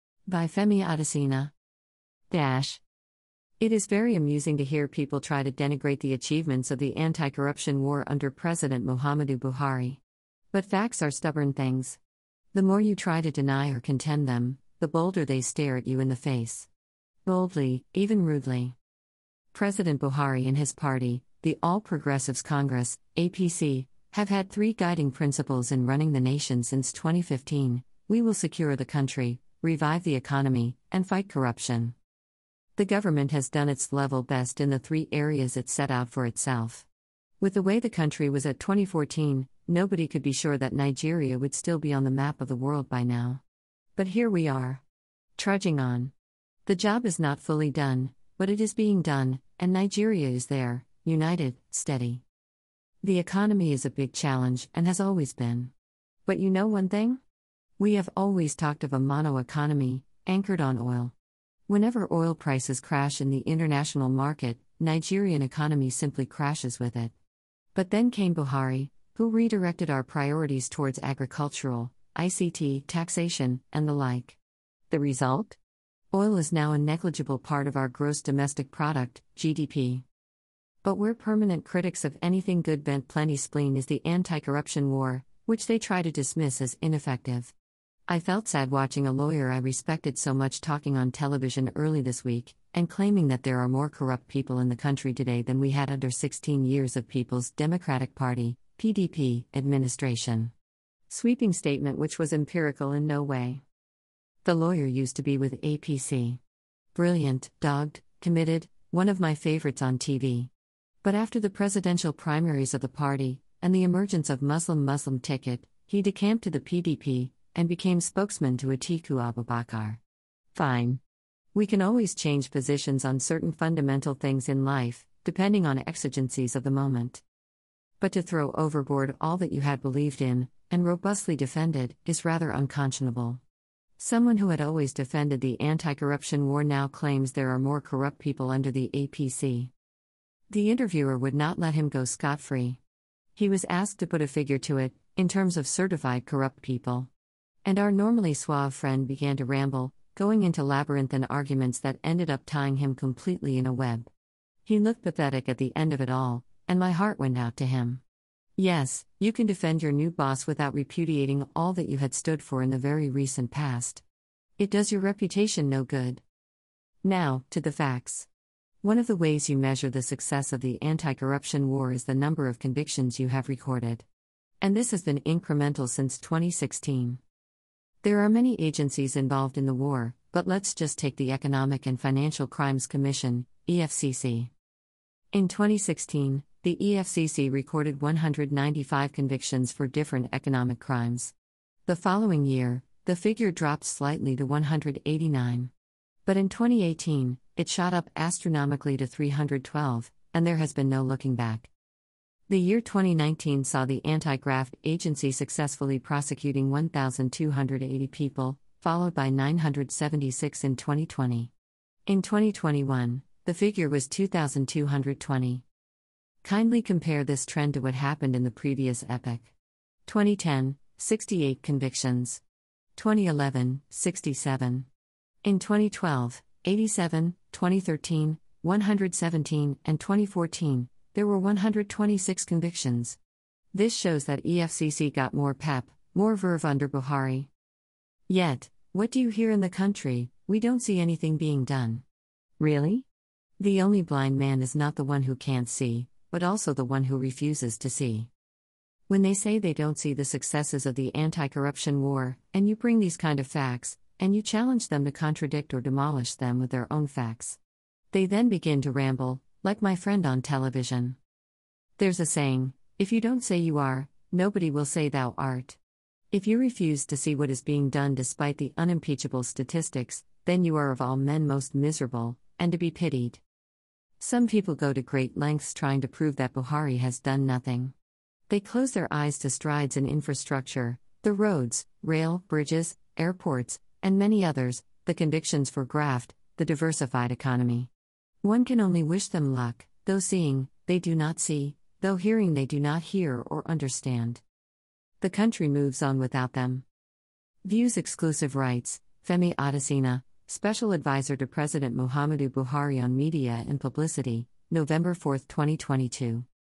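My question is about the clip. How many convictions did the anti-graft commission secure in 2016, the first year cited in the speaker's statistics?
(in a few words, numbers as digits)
195.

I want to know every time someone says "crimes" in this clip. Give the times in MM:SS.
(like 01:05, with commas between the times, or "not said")
03:02, 03:10.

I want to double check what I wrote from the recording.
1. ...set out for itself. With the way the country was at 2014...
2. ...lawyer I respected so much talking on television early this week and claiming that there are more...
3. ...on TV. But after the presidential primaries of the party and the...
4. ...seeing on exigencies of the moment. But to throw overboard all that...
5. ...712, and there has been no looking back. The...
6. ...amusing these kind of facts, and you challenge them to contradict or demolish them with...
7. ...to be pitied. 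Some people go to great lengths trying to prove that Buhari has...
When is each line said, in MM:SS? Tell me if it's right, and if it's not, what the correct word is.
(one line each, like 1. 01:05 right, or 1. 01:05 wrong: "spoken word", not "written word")
1. 00:35 right
2. 01:29 right
3. 01:49 right
4. 02:05 wrong: "depending", not "seeing"
5. 03:19 wrong: "312", not "712"
6. 04:12 wrong: "bring", not "amusing"
7. 04:32 right.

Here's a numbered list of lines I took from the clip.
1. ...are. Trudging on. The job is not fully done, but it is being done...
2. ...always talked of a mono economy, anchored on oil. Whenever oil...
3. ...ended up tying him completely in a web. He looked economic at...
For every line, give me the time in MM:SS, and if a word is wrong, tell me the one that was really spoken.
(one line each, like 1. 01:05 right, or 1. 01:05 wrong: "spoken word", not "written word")
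1. 00:44 right
2. 00:58 right
3. 02:32 wrong: "pathetic", not "economic".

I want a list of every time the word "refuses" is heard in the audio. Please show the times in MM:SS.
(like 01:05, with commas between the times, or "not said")
04:07, 04:26.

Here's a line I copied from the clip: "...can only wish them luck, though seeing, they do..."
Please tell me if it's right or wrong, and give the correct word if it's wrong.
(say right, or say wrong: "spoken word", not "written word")
right.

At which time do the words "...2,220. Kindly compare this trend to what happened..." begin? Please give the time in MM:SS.
03:34.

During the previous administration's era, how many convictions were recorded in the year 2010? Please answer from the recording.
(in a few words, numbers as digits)
68.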